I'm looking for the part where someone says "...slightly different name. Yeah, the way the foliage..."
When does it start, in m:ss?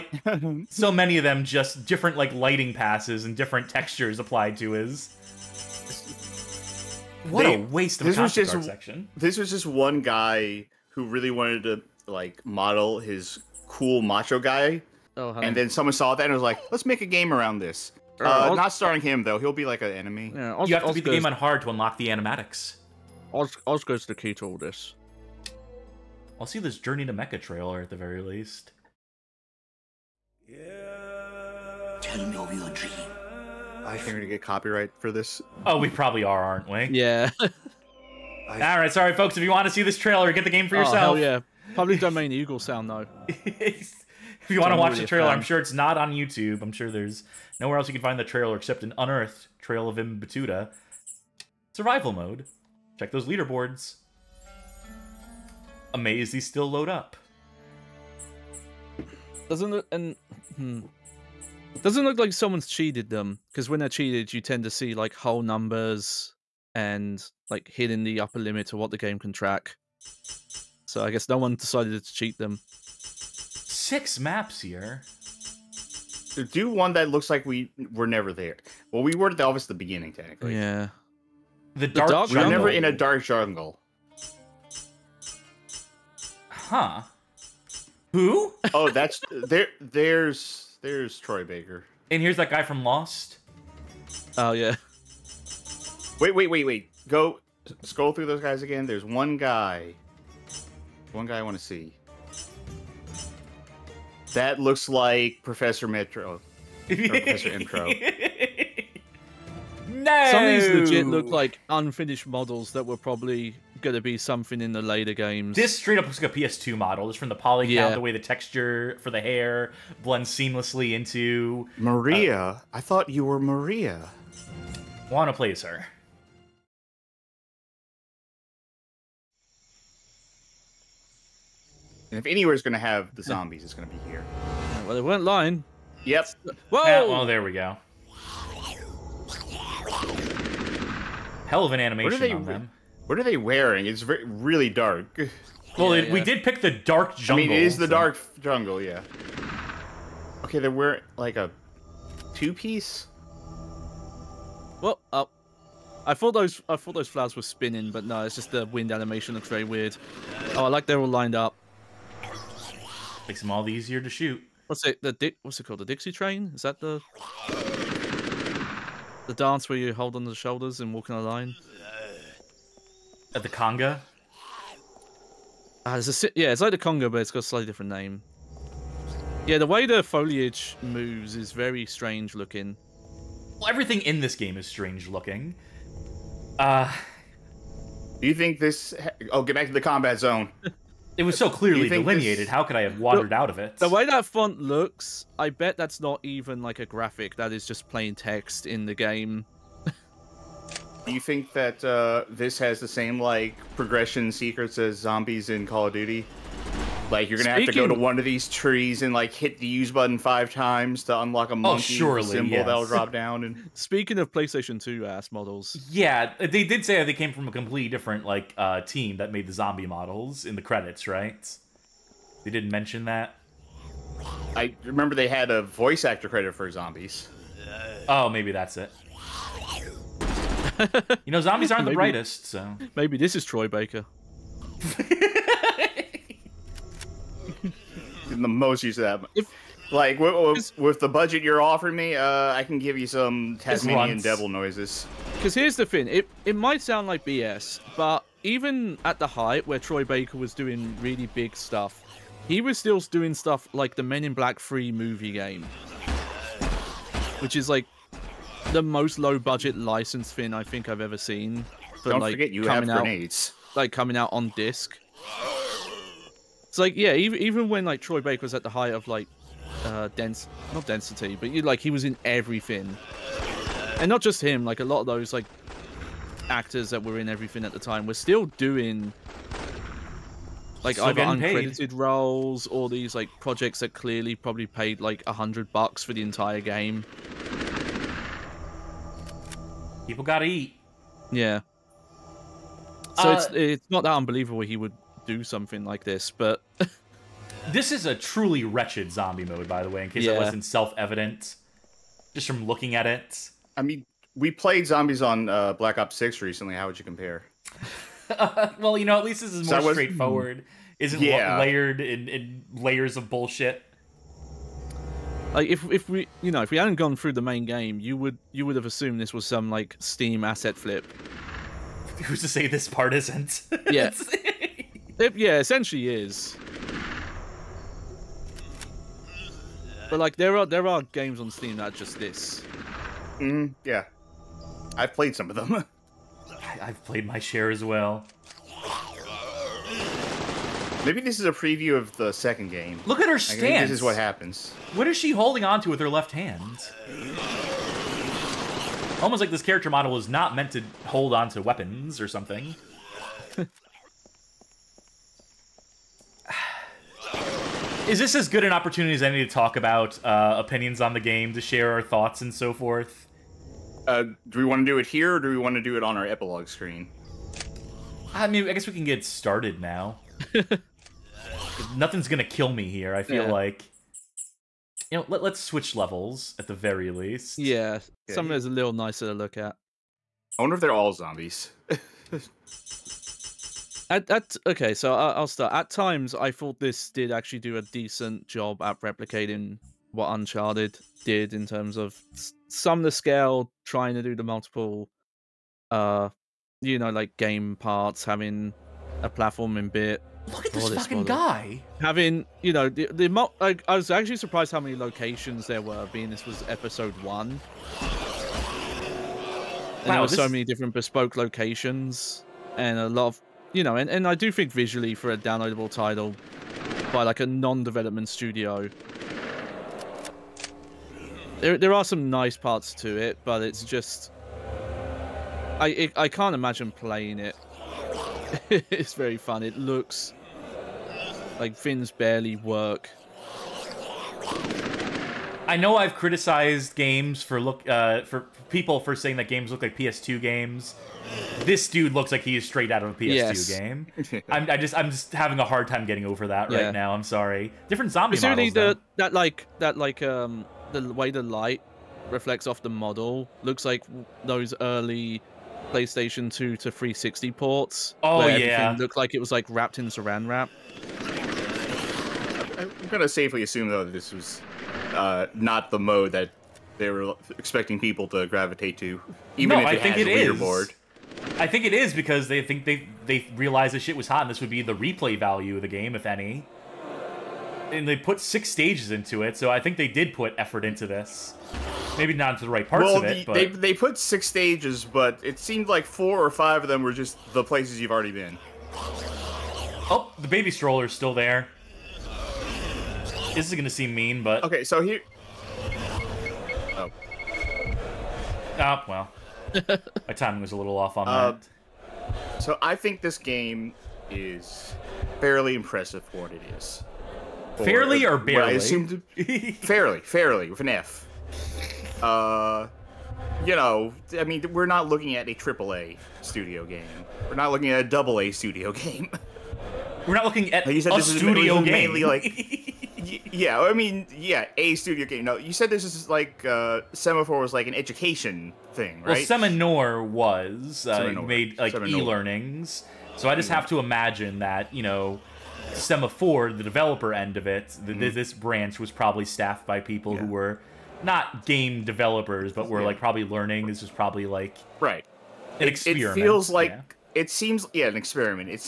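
2:57.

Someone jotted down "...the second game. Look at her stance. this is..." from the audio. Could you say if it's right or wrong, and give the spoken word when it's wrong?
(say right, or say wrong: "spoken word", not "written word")
right.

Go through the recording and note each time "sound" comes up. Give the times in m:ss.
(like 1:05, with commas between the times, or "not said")
0:42, 4:06.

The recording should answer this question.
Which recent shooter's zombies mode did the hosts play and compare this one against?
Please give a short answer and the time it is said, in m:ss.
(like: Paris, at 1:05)
Black Ops Six, at 5:05.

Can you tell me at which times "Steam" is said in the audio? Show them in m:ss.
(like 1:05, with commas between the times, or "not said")
5:19, 5:31.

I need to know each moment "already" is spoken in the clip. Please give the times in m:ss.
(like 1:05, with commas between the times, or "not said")
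8:08.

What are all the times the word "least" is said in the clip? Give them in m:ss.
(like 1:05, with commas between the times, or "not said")
0:28, 5:09, 6:17.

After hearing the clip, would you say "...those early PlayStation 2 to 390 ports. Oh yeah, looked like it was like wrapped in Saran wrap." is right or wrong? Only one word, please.
wrong.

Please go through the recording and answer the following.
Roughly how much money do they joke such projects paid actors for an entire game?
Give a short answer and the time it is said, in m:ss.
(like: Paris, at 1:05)
A hundred bucks, at 4:45.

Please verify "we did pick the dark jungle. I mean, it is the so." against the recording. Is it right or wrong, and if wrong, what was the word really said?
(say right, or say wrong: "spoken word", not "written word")
right.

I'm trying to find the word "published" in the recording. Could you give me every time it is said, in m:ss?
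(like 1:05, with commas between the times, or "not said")
not said.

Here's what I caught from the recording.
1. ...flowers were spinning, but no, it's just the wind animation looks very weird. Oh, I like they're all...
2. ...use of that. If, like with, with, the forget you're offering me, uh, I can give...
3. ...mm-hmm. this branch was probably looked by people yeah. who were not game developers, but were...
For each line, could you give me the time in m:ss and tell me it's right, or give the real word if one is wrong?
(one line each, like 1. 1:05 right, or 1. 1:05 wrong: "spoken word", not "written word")
1. 2:37 right
2. 3:58 wrong: "budget", not "forget"
3. 8:58 wrong: "staffed", not "looked".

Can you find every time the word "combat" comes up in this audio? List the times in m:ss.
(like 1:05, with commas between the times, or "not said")
3:09.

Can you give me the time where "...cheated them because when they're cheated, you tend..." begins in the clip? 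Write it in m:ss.
1:02.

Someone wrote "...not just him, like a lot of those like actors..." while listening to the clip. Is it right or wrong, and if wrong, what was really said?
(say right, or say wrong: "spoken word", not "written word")
right.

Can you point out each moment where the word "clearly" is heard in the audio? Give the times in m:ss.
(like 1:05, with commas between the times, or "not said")
3:11, 4:43.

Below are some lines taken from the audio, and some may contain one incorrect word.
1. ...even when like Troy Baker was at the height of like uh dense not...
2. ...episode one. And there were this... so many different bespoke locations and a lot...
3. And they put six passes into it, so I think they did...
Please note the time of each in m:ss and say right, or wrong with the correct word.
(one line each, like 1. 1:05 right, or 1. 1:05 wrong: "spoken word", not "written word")
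1. 4:27 right
2. 6:46 right
3. 7:57 wrong: "stages", not "passes".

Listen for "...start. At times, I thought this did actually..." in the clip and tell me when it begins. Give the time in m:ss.
6:25.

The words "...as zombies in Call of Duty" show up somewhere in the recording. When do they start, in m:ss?
3:24.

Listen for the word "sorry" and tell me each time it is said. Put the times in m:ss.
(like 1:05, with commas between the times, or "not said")
0:38, 7:27.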